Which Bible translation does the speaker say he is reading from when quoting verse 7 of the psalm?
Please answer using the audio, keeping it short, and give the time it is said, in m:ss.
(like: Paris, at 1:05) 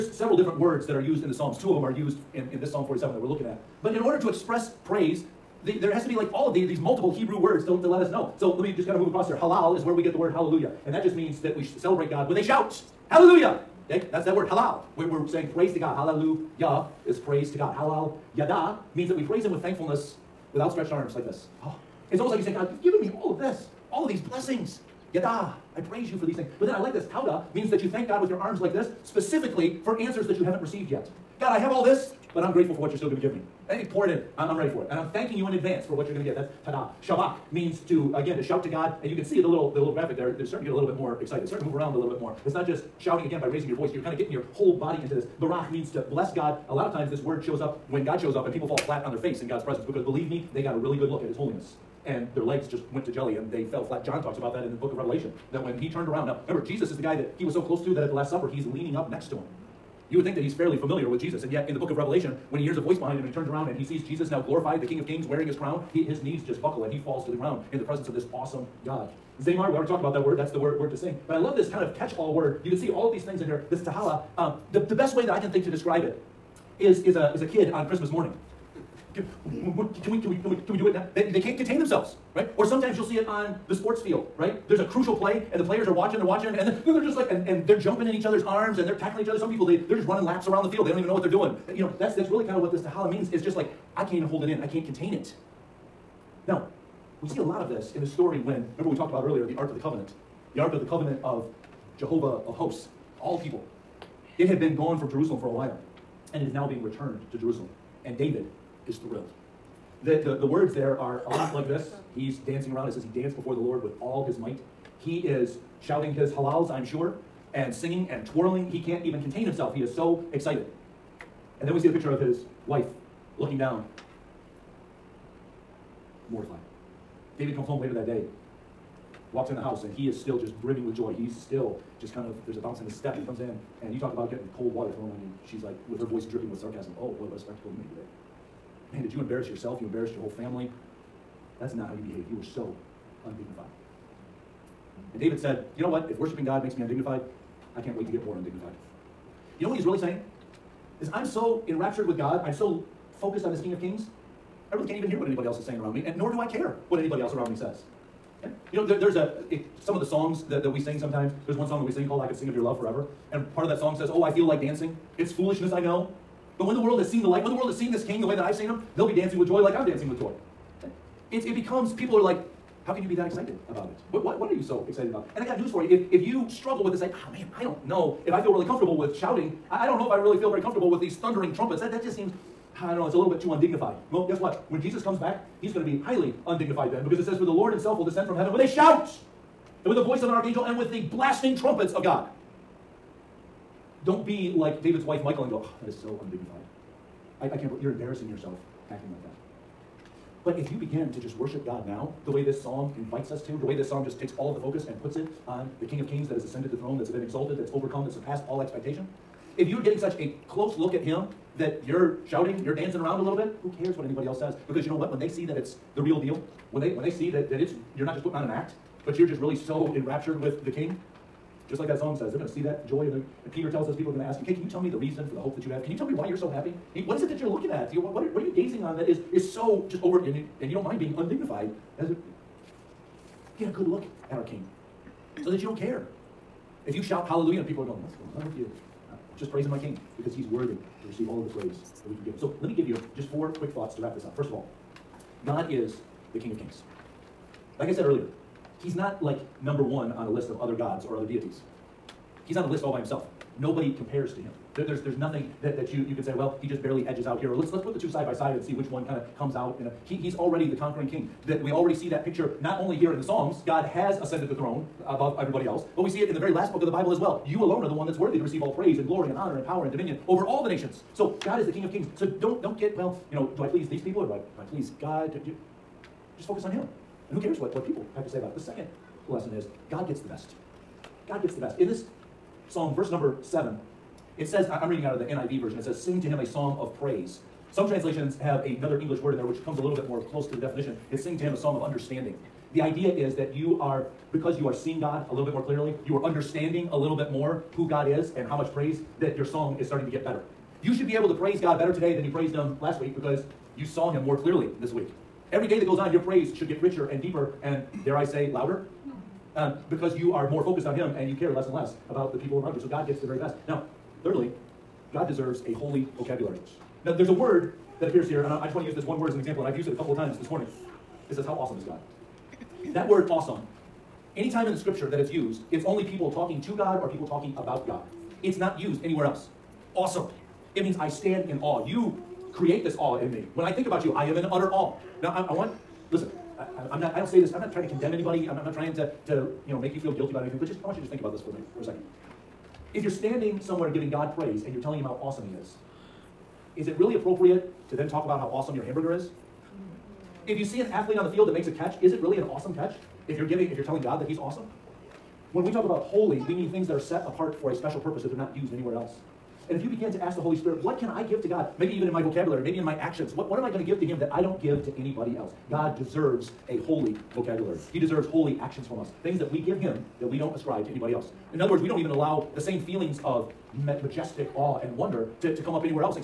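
NIV, at 4:45.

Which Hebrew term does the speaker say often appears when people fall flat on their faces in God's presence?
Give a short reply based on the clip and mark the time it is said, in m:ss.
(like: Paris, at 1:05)
Barach, at 0:45.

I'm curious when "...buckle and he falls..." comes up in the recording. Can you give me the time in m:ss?
1:06.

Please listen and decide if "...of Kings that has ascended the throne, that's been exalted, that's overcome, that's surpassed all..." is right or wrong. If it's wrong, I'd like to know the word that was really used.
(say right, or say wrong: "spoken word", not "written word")
right.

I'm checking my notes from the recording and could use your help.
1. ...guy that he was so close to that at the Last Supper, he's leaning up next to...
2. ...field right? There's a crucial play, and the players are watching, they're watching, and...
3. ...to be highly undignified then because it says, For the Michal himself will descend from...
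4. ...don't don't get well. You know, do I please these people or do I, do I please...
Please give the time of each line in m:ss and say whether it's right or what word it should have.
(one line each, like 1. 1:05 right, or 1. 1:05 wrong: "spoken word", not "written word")
1. 0:57 right
2. 1:24 right
3. 3:05 wrong: "Lord", not "Michal"
4. 4:32 right.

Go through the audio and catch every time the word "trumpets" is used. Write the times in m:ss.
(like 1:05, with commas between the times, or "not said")
3:01, 3:11.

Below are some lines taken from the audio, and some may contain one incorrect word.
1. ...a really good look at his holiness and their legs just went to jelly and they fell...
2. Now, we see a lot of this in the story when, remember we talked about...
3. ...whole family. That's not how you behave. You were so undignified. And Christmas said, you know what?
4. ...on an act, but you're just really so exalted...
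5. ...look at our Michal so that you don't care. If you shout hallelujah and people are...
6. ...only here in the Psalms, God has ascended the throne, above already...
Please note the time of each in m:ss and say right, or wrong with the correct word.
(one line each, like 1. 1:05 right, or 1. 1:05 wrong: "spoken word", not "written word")
1. 0:50 right
2. 1:36 right
3. 2:20 wrong: "David", not "Christmas"
4. 3:38 wrong: "enraptured", not "exalted"
5. 3:53 wrong: "King", not "Michal"
6. 4:22 wrong: "everybody", not "already".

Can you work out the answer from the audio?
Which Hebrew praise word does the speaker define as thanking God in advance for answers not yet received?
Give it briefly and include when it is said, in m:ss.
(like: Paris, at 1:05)
Tauda, at 0:27.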